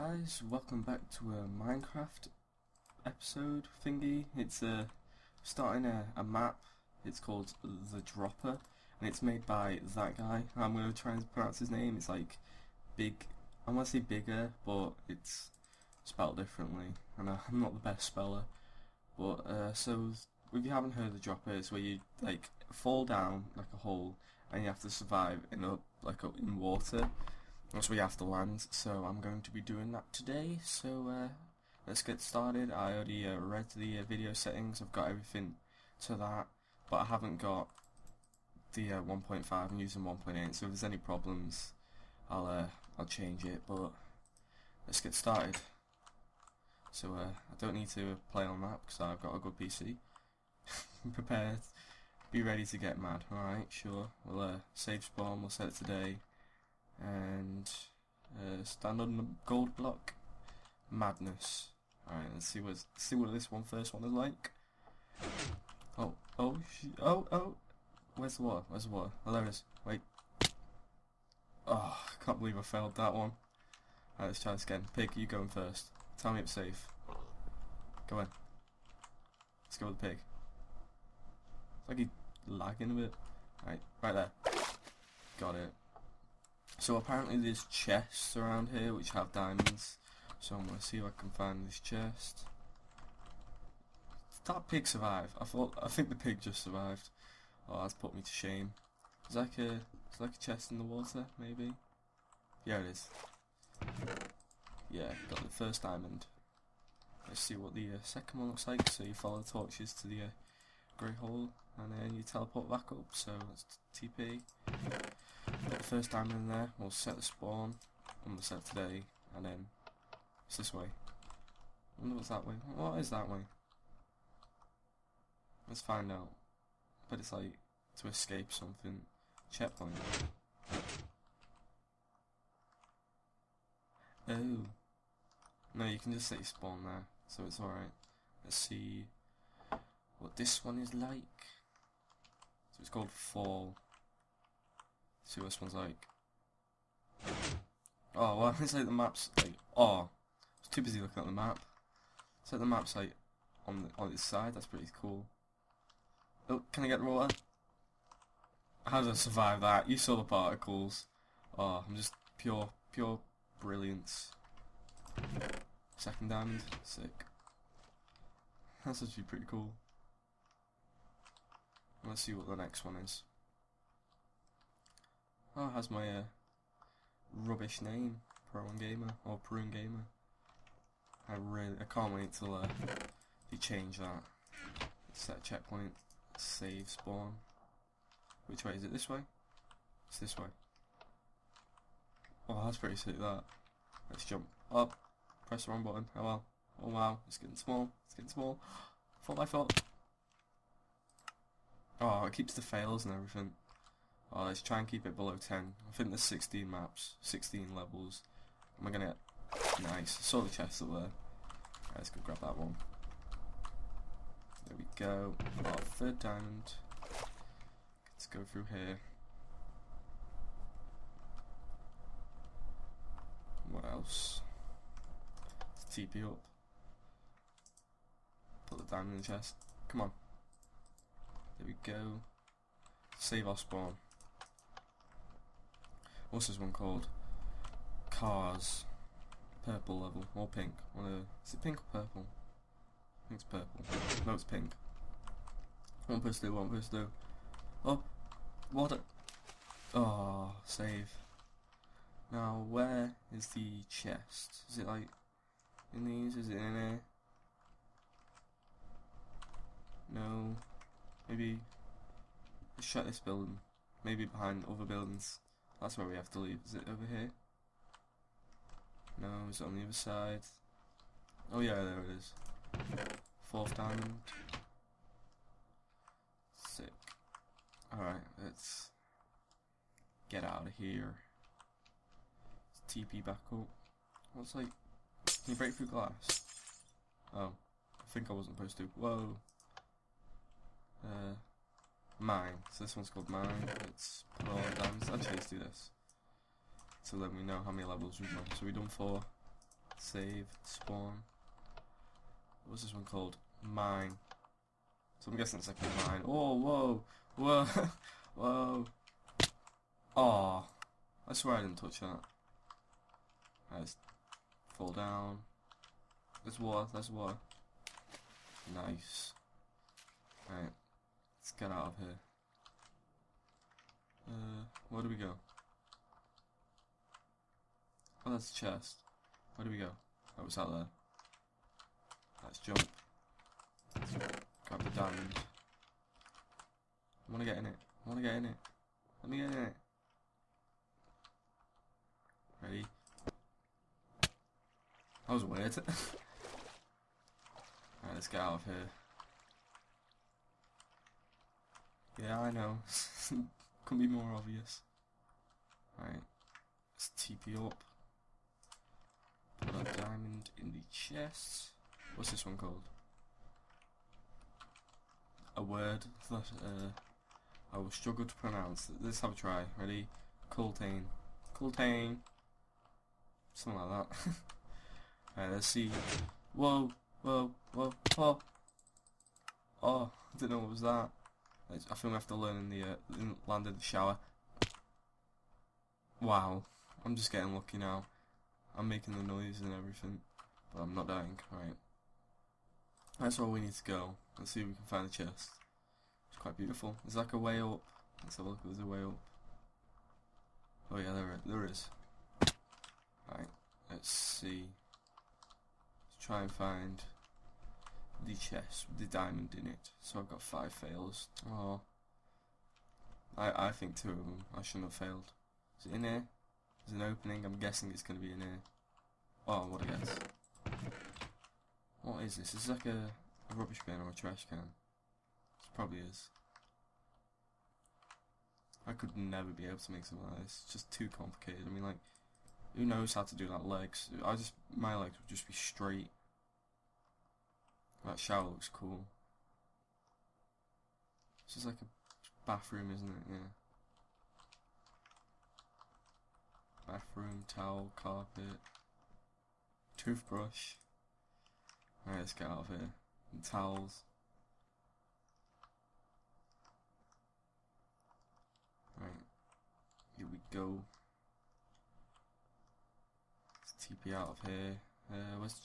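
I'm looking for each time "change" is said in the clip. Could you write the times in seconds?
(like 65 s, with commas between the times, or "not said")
43 s, 183 s.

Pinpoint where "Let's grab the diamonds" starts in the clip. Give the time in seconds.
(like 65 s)
333 s.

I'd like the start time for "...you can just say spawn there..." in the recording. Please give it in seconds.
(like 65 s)
135 s.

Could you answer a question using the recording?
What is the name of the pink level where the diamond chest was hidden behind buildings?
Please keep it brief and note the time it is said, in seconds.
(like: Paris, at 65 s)
Cars, at 238 s.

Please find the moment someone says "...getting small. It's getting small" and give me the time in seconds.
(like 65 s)
197 s.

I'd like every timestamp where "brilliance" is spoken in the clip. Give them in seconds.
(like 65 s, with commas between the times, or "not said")
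163 s.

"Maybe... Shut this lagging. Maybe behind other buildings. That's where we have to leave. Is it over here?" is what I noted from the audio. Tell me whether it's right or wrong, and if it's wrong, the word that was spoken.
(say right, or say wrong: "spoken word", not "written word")
wrong: "building", not "lagging".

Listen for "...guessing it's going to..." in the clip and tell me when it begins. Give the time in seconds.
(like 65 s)
417 s.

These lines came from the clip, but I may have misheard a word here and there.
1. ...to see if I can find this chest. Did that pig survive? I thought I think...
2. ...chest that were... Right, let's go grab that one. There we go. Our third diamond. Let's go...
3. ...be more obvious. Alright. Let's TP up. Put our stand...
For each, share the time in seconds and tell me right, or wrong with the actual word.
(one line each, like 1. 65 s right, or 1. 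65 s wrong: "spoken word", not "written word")
1. 90 s right
2. 210 s right
3. 353 s wrong: "diamond", not "stand".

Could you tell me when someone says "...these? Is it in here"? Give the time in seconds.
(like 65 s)
256 s.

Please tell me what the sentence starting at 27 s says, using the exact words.
Once we have the lands, so I'm going to be doing that today, so uh, let's get started.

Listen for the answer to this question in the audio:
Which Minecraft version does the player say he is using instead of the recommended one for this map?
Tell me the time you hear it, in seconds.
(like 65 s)
40 s.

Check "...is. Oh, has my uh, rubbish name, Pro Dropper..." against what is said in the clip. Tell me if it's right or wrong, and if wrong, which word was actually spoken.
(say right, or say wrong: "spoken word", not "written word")
wrong: "Gamer", not "Dropper".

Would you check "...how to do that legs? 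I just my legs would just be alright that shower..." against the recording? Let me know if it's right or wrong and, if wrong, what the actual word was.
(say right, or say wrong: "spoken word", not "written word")
wrong: "straight", not "alright".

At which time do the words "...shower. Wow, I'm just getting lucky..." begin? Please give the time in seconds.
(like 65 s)
383 s.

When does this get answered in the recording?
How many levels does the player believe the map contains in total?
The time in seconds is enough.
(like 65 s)
207 s.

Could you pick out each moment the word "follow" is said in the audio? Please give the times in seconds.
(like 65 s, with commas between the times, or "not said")
109 s.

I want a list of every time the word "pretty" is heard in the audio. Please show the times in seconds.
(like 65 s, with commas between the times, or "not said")
154 s, 169 s, 192 s.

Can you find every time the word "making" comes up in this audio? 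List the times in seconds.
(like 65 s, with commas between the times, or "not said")
388 s.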